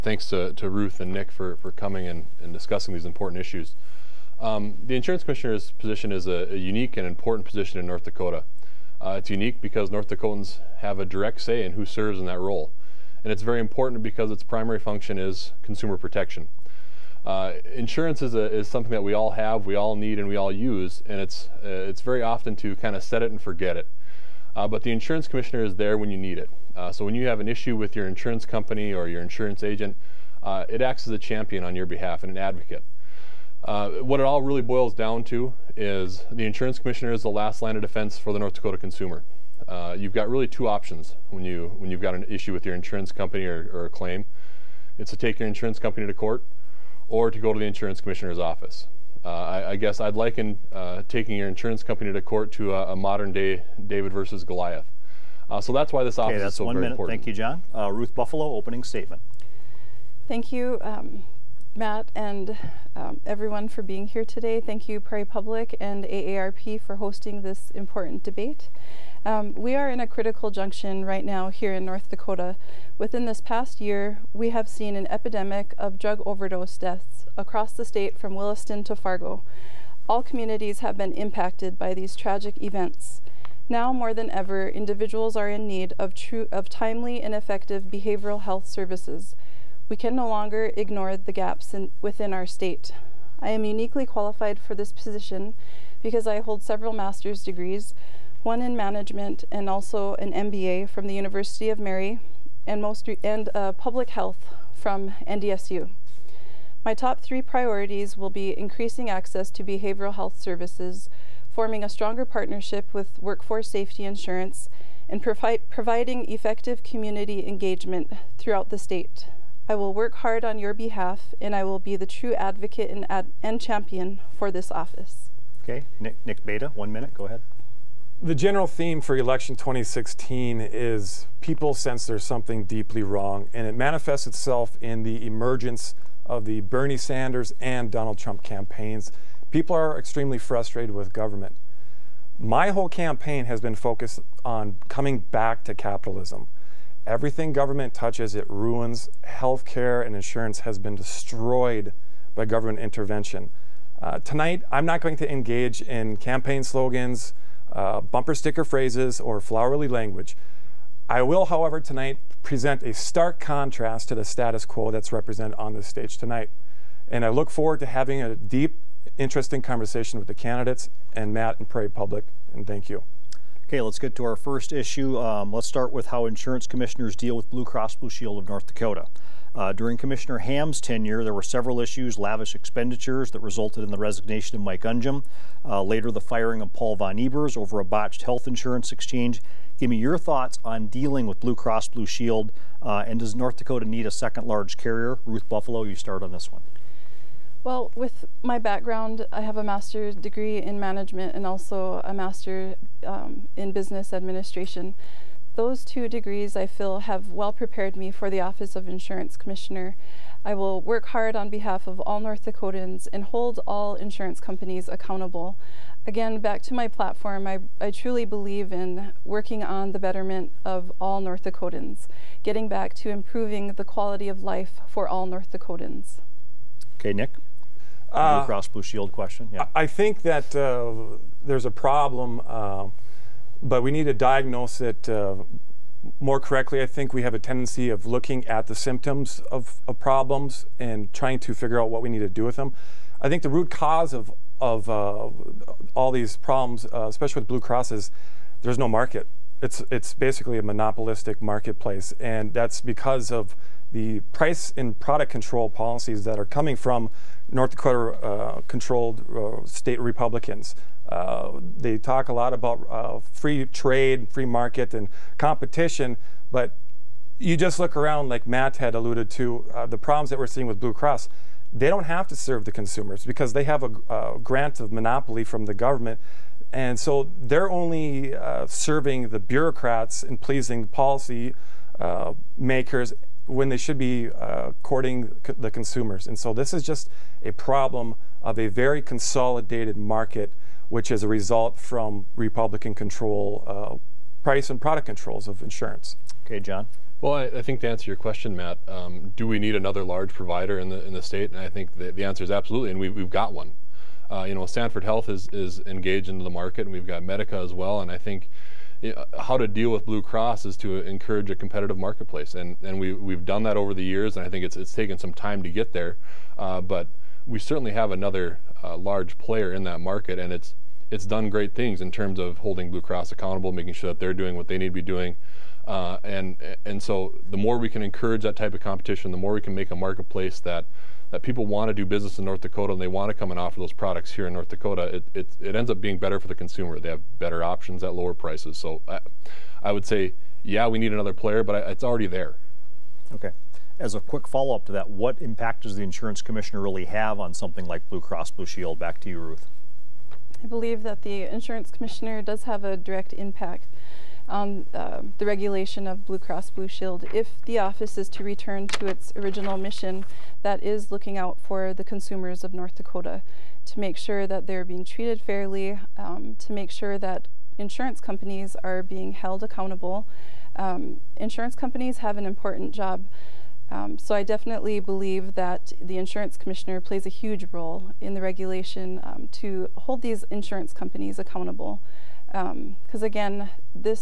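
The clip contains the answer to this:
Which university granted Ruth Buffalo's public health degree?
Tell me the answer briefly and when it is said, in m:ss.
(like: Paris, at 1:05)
NDSU, at 1:45.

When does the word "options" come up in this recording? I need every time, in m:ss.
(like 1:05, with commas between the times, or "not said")
0:40, 5:37.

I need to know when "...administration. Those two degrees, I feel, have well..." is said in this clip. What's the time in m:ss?
3:24.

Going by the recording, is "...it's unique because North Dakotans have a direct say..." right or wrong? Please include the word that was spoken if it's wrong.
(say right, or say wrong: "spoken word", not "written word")
right.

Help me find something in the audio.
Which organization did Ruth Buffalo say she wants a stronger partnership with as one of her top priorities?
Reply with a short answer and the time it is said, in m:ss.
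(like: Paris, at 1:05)
Workforce Safety Insurance, at 1:53.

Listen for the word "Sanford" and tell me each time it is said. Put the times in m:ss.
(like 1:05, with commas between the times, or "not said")
5:04.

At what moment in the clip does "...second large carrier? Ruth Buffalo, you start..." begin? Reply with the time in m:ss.
3:14.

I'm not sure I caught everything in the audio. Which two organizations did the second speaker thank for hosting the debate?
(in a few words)
Prairie Public and AARP.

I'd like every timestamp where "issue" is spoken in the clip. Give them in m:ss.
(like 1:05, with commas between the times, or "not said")
0:03, 0:27, 0:42, 2:54, 3:01.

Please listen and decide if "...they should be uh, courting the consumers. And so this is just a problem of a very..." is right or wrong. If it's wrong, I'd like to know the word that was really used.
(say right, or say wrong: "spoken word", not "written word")
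right.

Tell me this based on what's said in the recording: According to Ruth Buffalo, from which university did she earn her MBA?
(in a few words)
University of Mary.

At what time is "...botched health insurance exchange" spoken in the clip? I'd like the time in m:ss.
3:07.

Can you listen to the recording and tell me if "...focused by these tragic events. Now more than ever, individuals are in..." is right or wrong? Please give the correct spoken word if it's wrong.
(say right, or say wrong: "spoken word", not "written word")
wrong: "impacted", not "focused".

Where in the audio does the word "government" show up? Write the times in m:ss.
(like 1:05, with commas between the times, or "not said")
2:21, 2:27, 2:32, 4:35.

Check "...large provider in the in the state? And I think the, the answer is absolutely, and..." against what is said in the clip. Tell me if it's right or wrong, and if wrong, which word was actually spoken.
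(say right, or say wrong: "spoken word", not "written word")
right.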